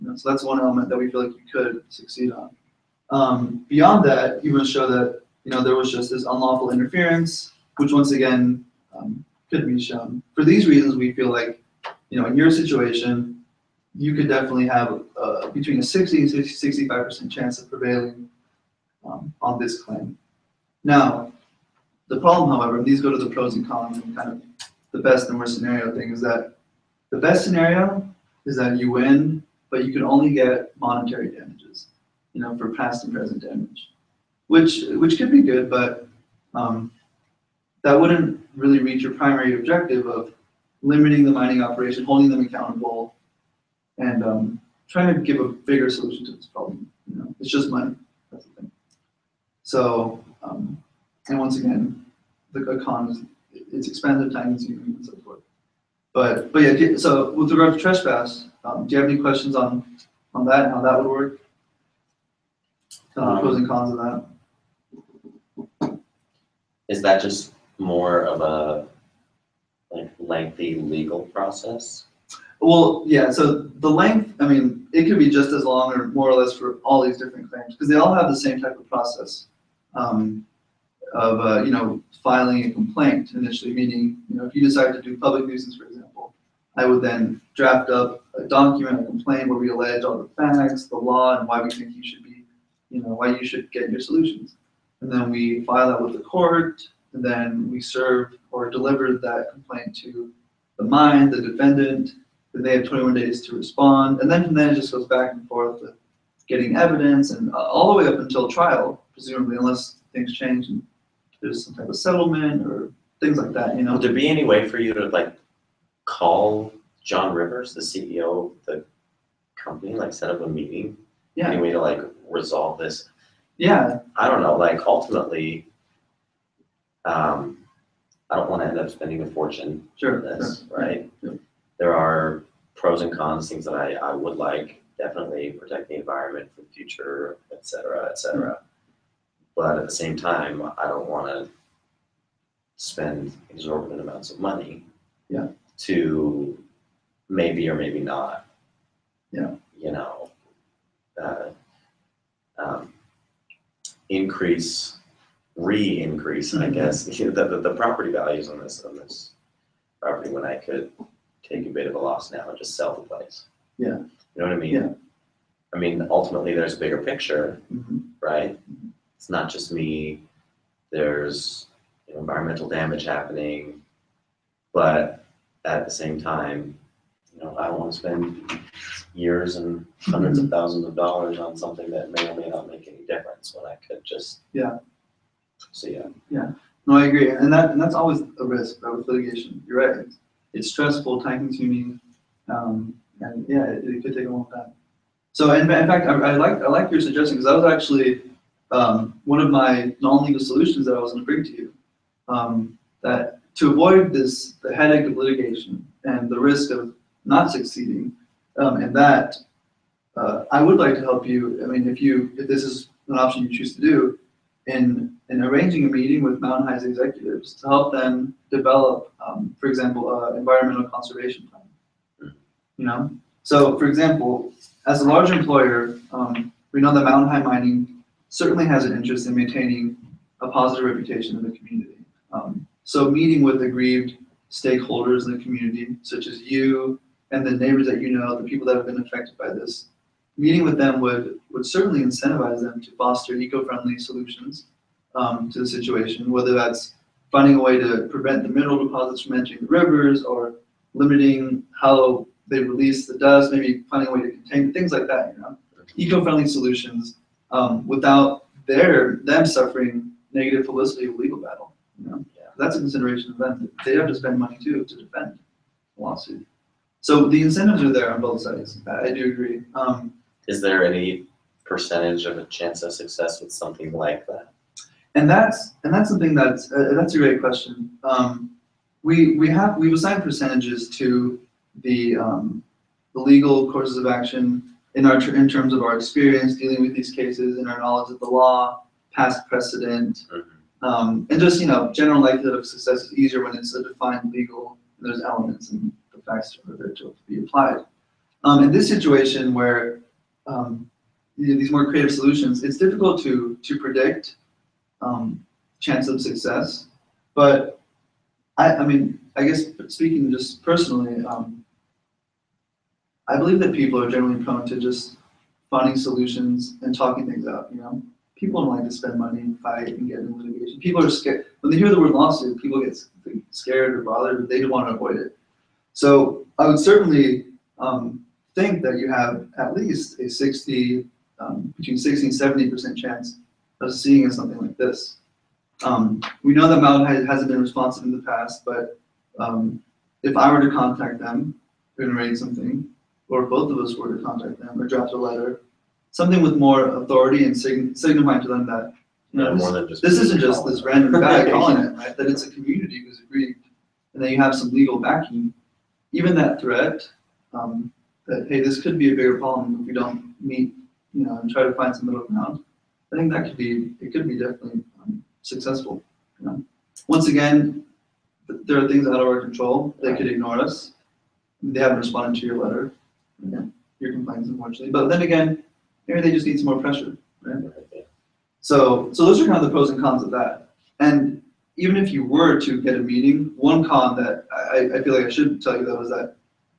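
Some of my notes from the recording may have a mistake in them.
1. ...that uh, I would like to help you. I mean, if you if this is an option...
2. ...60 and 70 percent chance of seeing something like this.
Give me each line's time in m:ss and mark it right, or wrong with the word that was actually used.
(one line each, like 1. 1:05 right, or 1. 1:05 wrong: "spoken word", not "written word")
1. 3:28 right
2. 5:31 right.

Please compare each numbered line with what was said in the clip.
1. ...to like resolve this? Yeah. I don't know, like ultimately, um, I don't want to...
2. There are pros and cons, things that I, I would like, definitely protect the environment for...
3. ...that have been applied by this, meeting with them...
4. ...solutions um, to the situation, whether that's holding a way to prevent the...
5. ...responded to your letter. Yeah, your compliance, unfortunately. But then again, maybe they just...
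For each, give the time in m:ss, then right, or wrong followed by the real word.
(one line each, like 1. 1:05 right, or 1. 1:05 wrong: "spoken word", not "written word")
1. 2:01 right
2. 2:11 right
3. 3:58 wrong: "affected", not "applied"
4. 4:03 wrong: "finding", not "holding"
5. 6:11 right.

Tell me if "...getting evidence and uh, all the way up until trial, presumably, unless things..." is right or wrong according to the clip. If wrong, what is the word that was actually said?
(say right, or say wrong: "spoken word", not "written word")
right.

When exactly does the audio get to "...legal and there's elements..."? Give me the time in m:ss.
4:54.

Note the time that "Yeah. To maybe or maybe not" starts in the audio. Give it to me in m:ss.
2:25.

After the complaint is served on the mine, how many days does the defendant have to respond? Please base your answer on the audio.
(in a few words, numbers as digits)
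21 days.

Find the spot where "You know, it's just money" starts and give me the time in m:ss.
0:47.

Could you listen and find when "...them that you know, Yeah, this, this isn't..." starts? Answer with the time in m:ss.
5:48.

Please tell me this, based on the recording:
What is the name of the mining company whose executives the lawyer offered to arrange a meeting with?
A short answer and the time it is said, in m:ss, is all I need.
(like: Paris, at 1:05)
Mountain High Mining, at 3:47.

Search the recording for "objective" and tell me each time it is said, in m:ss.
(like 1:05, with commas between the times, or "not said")
0:39.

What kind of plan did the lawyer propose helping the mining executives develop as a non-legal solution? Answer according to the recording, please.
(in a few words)
Environmental conservation plan.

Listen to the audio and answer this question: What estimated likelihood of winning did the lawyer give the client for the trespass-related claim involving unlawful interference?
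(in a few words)
60 to 65 percent.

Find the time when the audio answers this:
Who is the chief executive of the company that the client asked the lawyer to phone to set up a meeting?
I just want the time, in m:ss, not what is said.
1:57.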